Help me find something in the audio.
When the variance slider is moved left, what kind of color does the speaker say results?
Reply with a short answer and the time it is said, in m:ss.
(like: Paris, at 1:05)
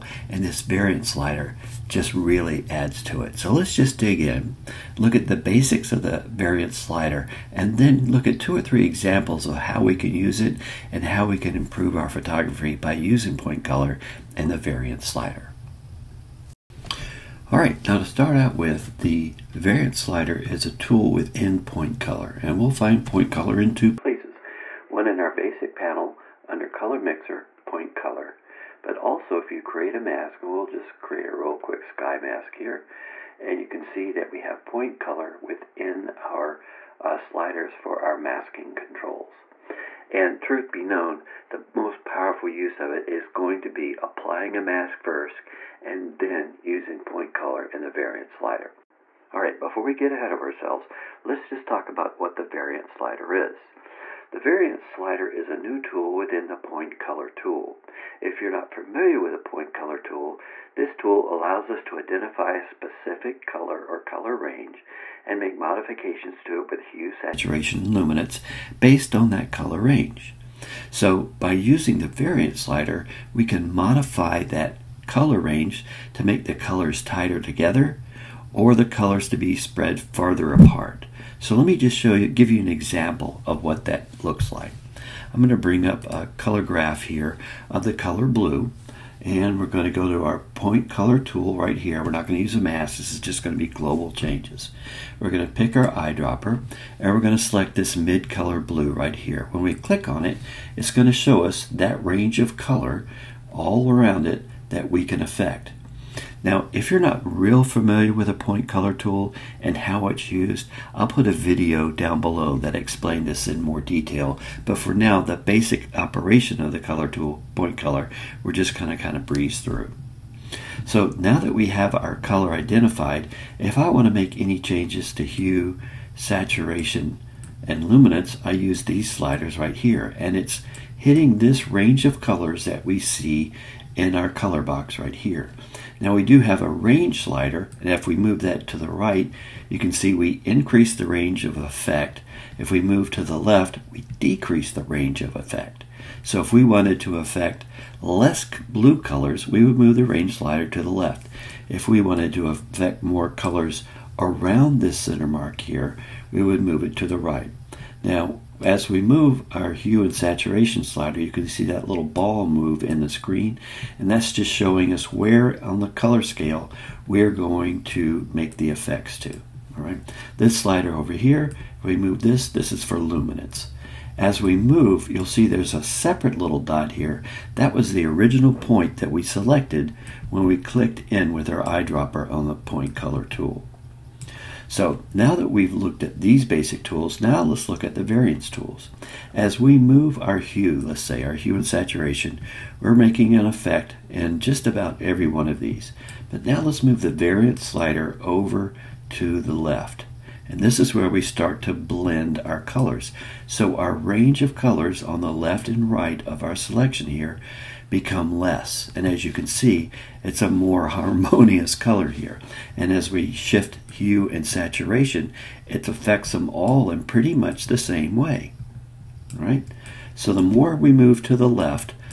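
Harmonious, at 3:30.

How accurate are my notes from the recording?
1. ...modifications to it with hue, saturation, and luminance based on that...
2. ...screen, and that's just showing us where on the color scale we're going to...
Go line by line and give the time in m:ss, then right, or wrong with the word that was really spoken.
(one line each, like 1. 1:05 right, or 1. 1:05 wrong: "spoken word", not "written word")
1. 1:05 right
2. 2:43 right.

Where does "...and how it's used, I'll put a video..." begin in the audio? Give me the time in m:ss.
1:49.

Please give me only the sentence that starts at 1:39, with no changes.
When we click on it, it's going to show us that range of color all around it that we can affect.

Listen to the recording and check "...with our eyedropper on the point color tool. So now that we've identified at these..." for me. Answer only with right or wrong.
wrong.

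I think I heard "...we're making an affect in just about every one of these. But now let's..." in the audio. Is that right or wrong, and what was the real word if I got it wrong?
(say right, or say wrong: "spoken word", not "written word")
wrong: "effect", not "affect".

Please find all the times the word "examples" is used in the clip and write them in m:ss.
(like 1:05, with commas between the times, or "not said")
0:08, 1:22.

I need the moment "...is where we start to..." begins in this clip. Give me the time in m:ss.
3:20.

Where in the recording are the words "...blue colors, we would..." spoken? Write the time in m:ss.
2:28.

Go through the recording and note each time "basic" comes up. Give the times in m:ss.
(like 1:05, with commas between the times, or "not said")
0:05, 0:25, 1:55, 3:06.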